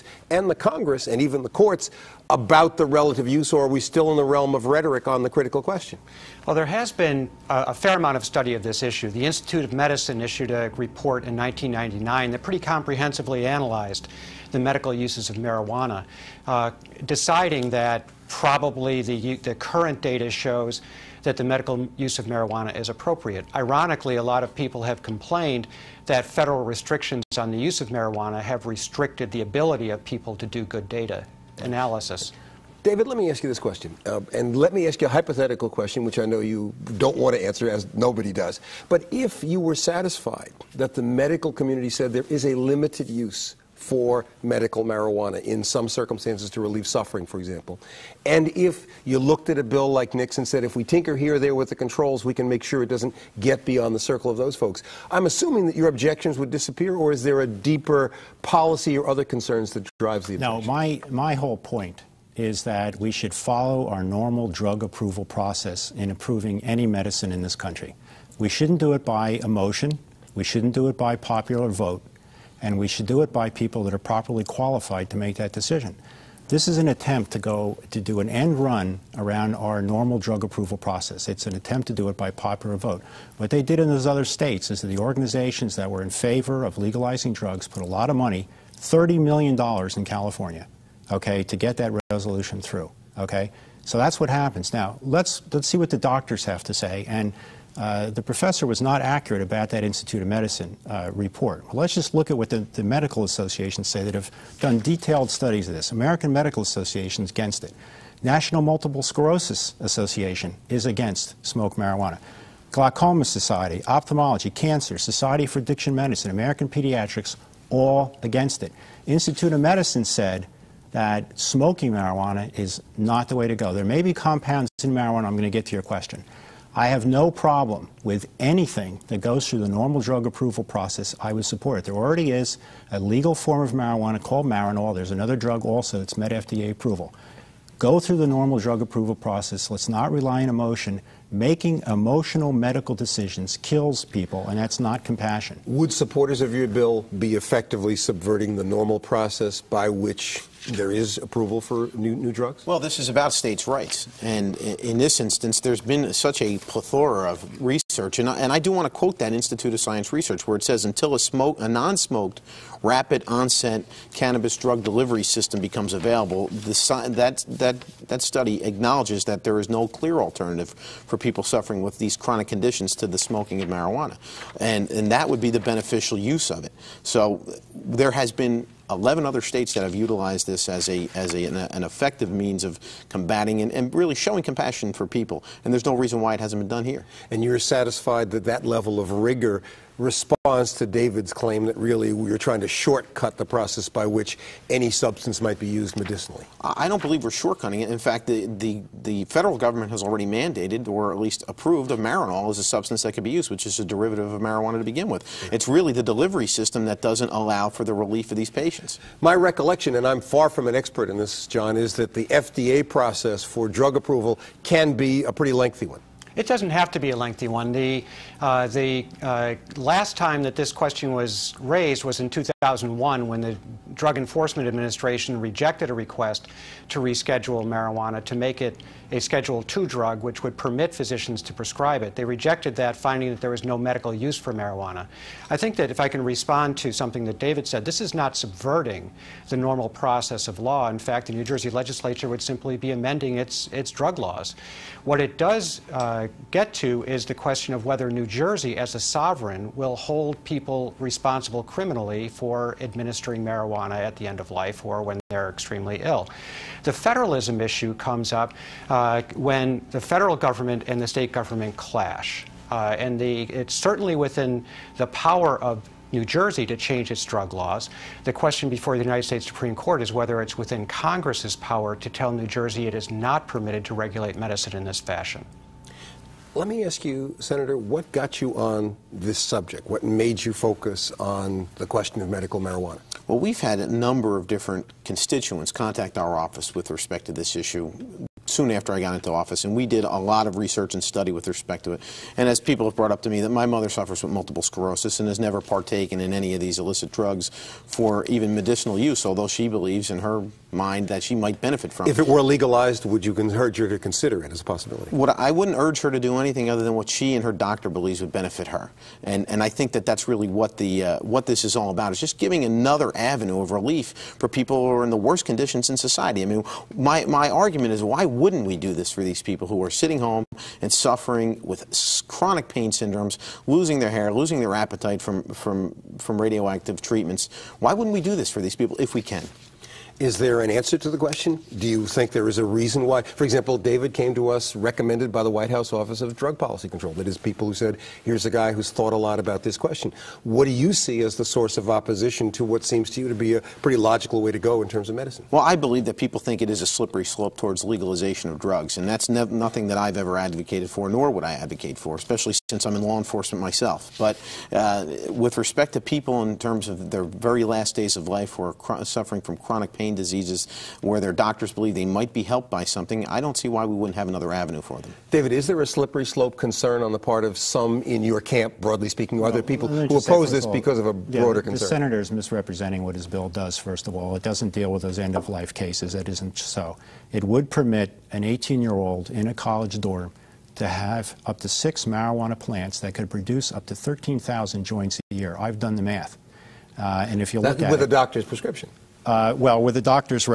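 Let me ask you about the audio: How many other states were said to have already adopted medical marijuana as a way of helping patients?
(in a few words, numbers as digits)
11.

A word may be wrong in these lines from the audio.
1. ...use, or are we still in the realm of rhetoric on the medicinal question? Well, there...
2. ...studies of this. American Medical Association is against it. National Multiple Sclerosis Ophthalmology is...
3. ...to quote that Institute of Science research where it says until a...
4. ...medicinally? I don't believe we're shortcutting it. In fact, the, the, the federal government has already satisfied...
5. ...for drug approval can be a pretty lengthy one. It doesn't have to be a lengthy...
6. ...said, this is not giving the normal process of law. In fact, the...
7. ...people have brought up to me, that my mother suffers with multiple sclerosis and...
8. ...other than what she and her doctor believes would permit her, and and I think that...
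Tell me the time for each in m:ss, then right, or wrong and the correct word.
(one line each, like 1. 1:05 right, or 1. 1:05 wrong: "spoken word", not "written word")
1. 0:03 wrong: "critical", not "medicinal"
2. 1:45 wrong: "Association", not "Ophthalmology"
3. 2:38 right
4. 3:15 wrong: "mandated", not "satisfied"
5. 3:33 right
6. 3:57 wrong: "subverting", not "giving"
7. 4:52 right
8. 5:06 wrong: "benefit", not "permit".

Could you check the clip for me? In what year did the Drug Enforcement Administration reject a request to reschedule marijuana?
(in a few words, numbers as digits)
2001.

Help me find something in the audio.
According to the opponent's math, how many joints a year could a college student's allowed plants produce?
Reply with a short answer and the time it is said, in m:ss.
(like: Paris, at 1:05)
13,000, at 6:23.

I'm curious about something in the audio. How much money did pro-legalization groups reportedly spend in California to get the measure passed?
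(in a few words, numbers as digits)
$30 million.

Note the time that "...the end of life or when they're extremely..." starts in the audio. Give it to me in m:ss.
4:14.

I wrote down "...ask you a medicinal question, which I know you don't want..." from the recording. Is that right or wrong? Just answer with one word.
wrong.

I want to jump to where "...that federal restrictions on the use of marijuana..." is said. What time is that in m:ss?
0:26.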